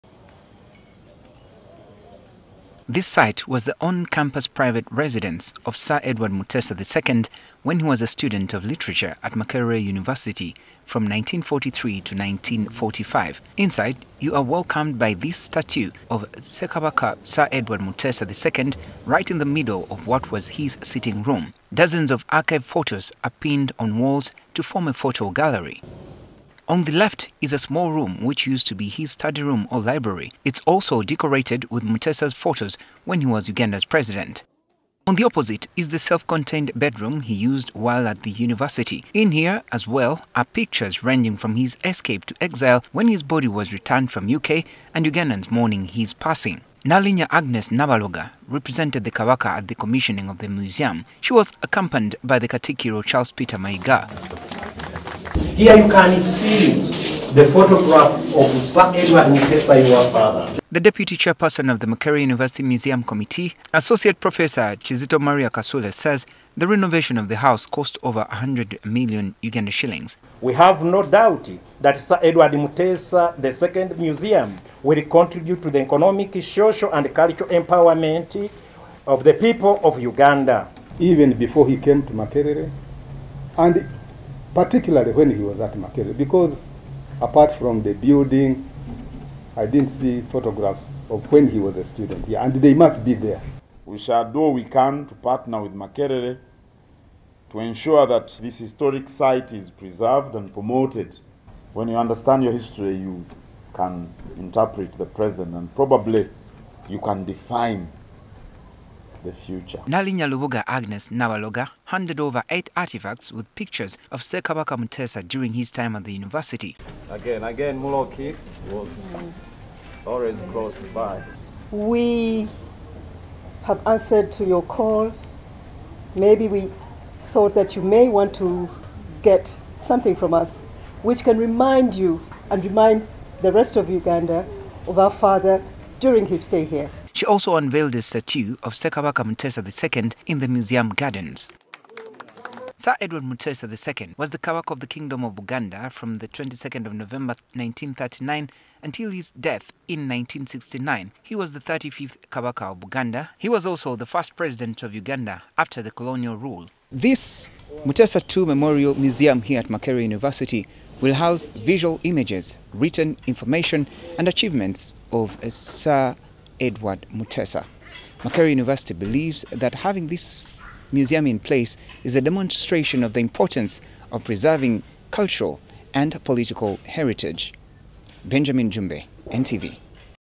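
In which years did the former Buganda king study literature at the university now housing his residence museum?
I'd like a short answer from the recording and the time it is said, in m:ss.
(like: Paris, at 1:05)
1943 to 1945, at 0:11.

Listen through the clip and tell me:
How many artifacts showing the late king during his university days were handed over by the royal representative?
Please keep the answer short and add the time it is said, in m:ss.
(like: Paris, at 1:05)
8, at 1:52.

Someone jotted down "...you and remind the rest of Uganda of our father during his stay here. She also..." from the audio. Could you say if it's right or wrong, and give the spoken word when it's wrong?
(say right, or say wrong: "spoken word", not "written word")
right.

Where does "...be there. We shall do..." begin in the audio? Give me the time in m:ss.
1:33.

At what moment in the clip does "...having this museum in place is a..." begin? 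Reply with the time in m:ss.
2:49.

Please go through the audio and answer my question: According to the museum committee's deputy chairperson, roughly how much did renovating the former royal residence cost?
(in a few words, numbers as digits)
Over 100 million Uganda shillings.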